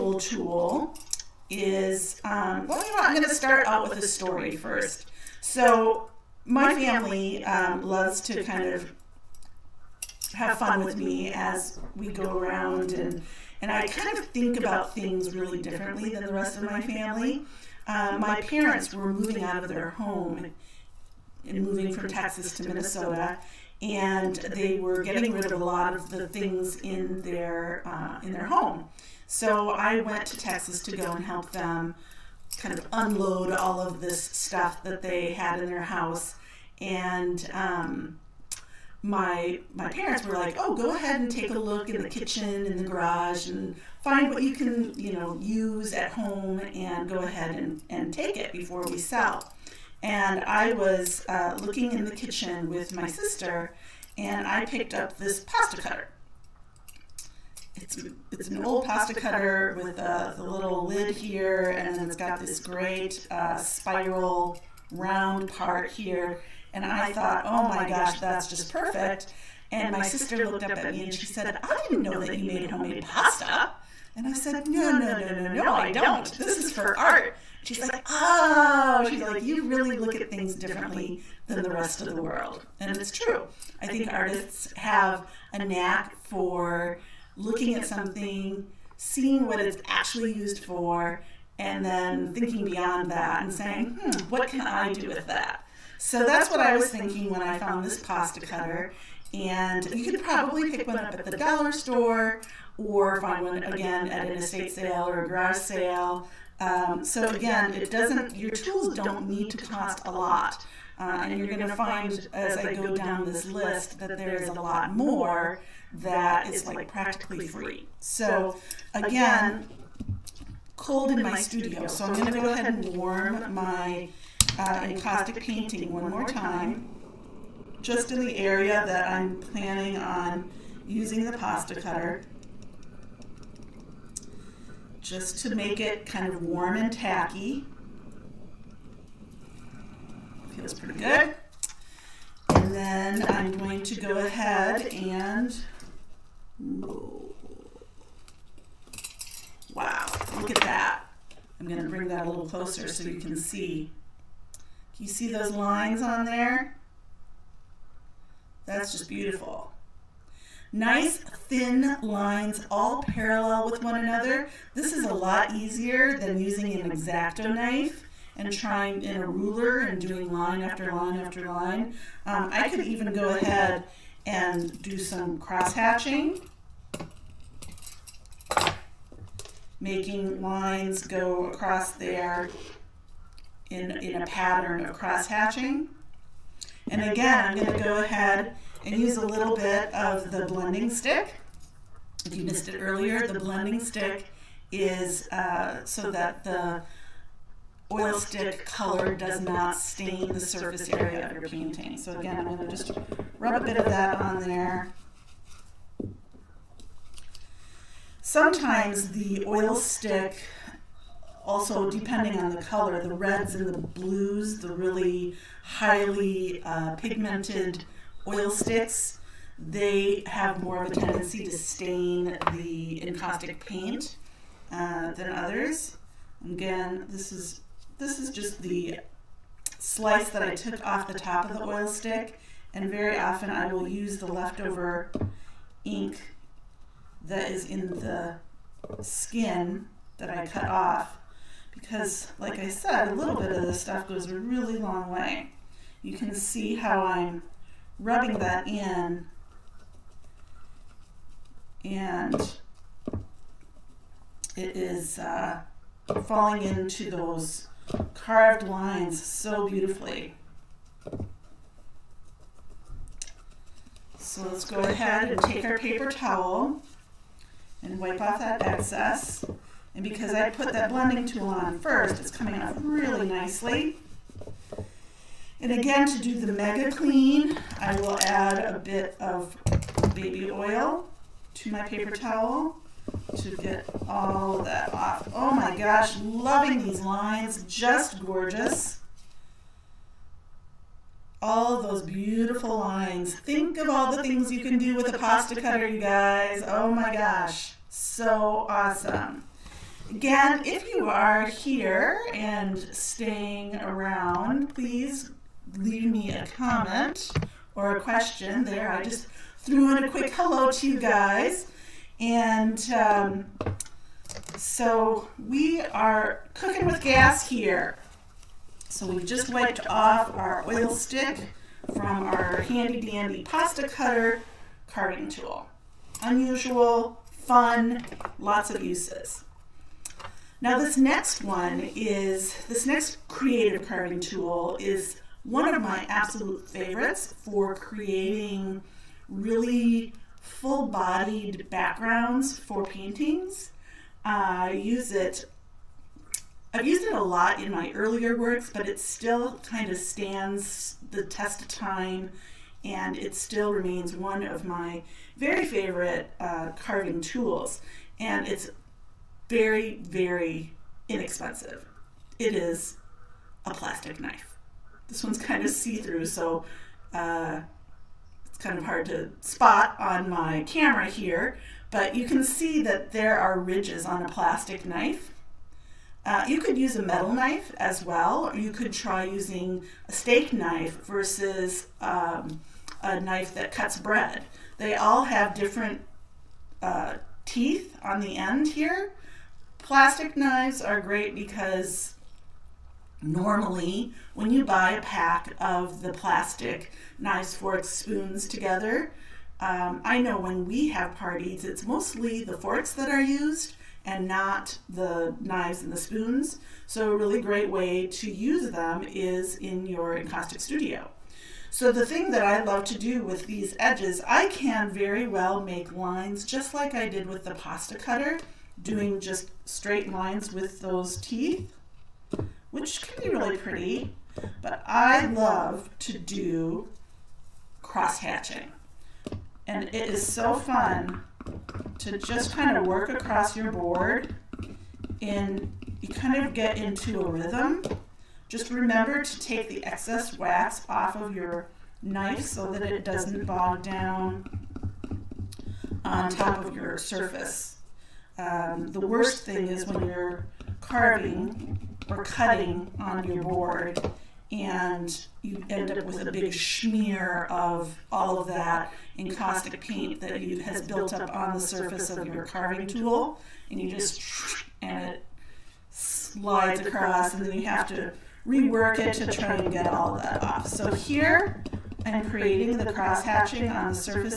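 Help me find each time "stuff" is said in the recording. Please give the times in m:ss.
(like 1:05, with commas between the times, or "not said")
0:34, 4:03.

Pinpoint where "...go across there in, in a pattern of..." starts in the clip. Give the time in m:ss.
3:01.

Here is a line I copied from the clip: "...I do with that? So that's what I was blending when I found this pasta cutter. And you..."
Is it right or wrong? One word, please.
wrong.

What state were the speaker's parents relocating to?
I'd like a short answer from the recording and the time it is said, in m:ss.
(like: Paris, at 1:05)
Minnesota, at 0:22.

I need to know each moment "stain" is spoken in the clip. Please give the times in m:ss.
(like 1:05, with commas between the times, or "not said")
3:19, 3:41.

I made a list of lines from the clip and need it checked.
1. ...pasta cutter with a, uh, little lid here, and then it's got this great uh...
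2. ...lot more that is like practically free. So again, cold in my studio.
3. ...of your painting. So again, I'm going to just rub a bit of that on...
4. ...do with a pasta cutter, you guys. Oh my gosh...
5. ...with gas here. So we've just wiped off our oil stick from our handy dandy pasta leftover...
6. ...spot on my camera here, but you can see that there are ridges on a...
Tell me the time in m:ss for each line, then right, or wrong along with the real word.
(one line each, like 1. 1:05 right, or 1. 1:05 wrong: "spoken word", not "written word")
1. 0:58 right
2. 1:54 right
3. 3:21 right
4. 4:54 right
5. 5:16 wrong: "cutter", not "leftover"
6. 6:09 right.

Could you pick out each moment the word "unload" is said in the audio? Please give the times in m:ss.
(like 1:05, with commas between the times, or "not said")
0:32.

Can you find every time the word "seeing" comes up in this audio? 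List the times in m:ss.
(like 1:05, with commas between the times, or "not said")
1:28.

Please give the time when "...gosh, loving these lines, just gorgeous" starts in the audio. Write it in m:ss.
4:45.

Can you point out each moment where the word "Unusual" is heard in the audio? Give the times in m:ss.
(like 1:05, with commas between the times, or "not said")
5:26.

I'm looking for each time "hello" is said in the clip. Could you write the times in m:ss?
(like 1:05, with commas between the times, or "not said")
5:10.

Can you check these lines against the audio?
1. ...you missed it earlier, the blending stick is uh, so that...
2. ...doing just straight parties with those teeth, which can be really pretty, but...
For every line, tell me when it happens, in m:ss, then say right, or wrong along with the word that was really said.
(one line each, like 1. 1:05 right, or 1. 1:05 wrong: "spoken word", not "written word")
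1. 3:12 right
2. 6:58 wrong: "lines", not "parties".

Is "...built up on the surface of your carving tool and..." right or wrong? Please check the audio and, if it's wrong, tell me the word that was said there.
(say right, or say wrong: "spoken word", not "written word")
right.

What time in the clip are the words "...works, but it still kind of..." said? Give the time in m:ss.
5:48.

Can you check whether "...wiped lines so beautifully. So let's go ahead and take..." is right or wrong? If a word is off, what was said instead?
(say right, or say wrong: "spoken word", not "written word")
wrong: "carved", not "wiped".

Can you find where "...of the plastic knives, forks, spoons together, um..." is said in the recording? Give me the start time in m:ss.
6:35.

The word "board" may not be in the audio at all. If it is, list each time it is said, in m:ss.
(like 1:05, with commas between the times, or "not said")
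7:13, 7:33.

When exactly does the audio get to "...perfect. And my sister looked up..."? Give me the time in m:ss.
1:08.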